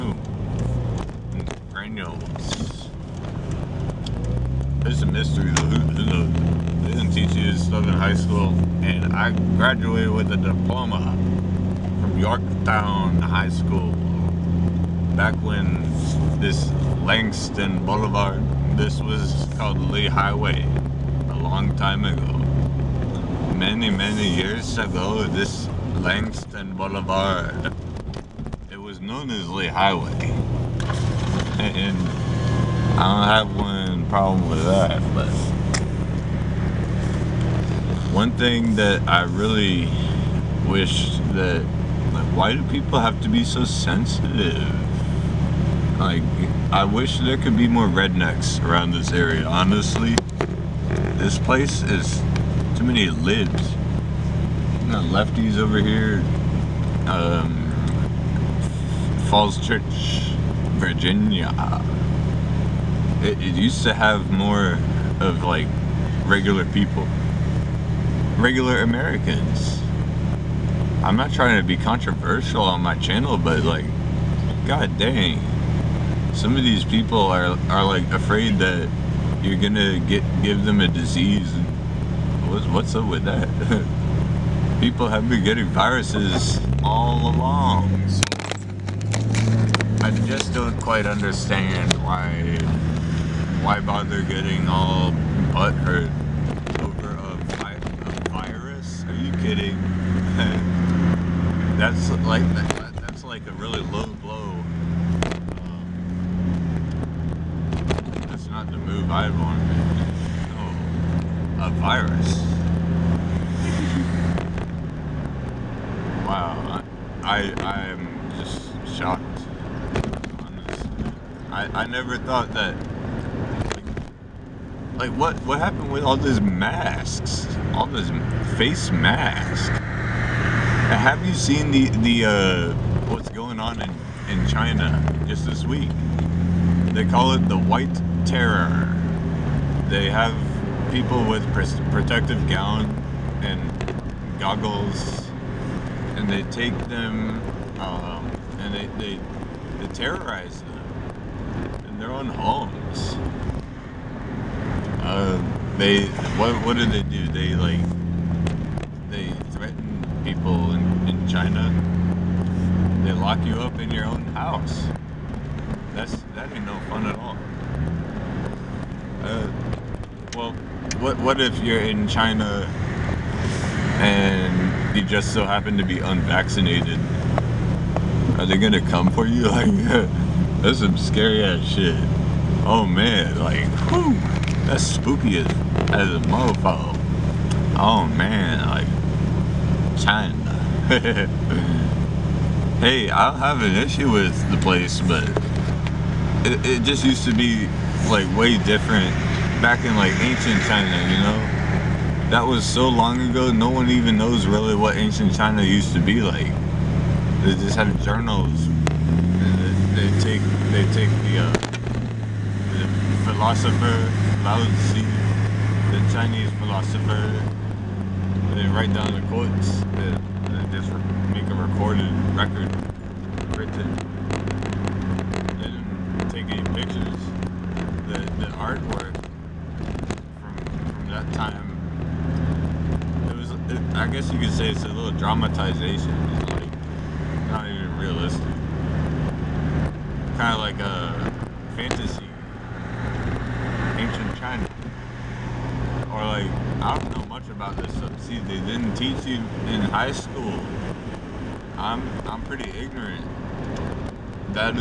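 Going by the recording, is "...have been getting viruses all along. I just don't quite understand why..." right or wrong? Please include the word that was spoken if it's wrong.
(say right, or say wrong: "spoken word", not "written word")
right.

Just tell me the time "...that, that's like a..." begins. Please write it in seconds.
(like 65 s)
102 s.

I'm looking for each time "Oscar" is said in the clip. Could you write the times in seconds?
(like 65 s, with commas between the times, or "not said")
not said.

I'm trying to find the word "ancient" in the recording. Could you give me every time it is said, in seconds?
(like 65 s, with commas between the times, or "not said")
200 s, 204 s.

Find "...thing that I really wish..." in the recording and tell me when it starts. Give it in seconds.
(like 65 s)
38 s.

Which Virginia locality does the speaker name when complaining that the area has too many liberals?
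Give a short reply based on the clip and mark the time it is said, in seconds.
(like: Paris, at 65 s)
Falls Church, at 59 s.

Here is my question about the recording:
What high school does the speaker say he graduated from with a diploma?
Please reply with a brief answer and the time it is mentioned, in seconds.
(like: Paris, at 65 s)
Yorktown High School, at 12 s.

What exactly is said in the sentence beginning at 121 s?
I, I, never thought that like what what happened with all these masks?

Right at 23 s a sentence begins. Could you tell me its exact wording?
Many, many years ago, this Langston Boulevard, it was known as Lee Highway.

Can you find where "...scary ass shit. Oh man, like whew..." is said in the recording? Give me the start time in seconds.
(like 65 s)
180 s.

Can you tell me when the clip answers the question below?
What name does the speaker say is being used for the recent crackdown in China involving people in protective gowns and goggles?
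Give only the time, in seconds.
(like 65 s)
137 s.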